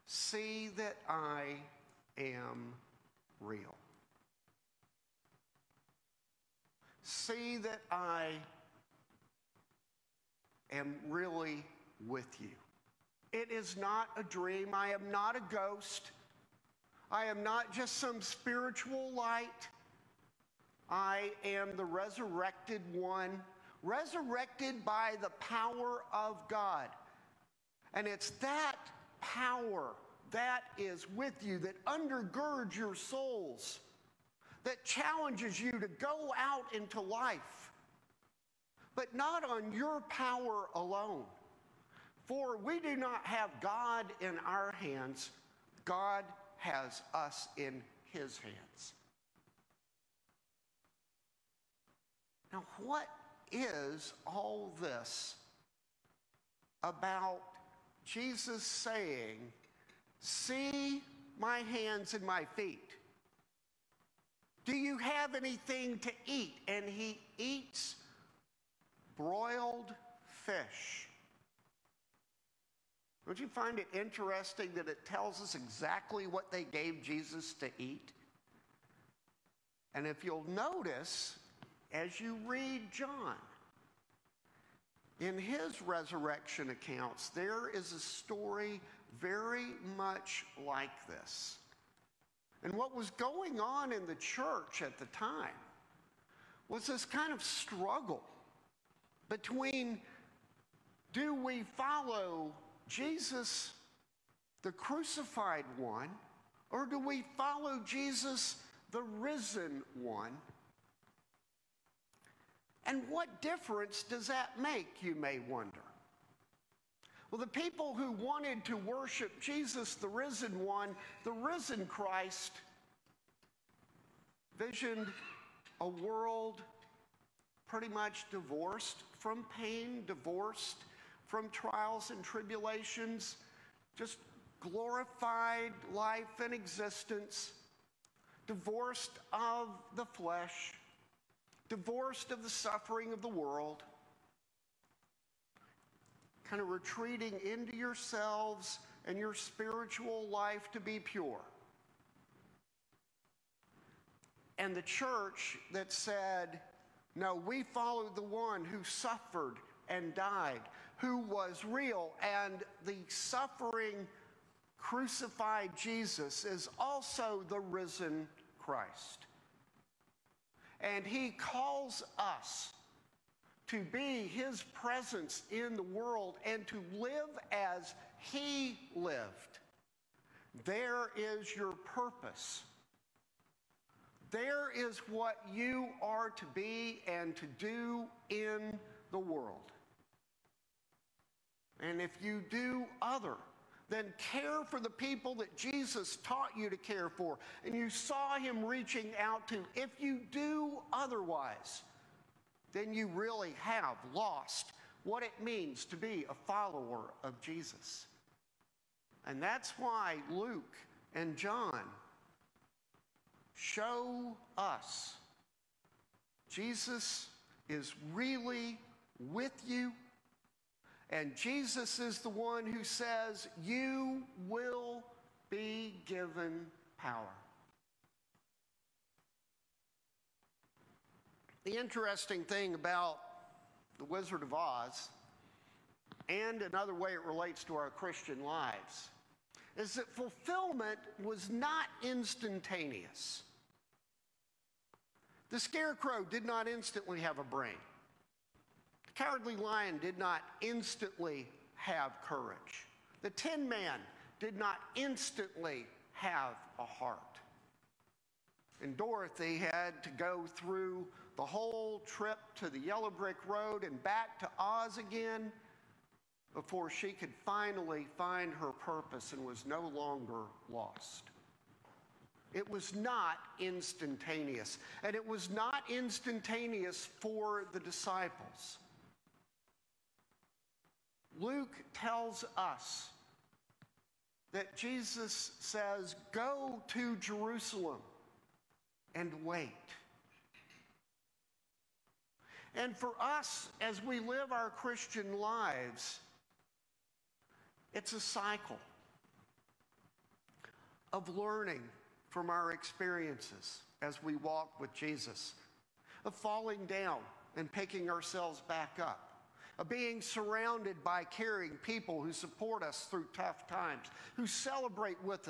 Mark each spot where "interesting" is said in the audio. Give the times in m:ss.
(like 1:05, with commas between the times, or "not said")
1:13, 3:51.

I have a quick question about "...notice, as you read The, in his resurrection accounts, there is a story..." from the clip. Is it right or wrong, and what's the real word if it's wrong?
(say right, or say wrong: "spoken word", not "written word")
wrong: "John", not "The".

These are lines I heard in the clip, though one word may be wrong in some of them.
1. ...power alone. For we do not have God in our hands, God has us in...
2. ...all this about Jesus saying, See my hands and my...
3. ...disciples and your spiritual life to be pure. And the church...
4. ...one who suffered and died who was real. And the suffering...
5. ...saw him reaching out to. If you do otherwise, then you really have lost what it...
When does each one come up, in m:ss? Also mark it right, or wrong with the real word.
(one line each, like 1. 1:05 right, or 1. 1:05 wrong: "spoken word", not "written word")
1. 0:40 right
2. 0:54 right
3. 2:27 wrong: "yourselves", not "disciples"
4. 2:38 right
5. 3:17 right.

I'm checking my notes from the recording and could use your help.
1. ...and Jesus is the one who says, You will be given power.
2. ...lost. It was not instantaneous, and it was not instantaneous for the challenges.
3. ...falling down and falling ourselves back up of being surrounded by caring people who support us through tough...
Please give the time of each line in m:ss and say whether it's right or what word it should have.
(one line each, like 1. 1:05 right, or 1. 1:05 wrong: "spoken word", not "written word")
1. 3:41 right
2. 4:30 wrong: "disciples", not "challenges"
3. 5:06 wrong: "picking", not "falling".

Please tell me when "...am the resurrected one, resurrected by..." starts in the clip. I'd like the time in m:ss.
0:21.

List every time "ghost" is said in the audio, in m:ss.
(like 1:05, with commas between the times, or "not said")
0:15.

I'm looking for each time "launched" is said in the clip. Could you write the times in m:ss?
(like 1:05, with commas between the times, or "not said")
not said.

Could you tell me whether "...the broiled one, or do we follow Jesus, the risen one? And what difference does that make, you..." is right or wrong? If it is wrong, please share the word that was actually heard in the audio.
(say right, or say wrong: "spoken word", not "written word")
wrong: "crucified", not "broiled".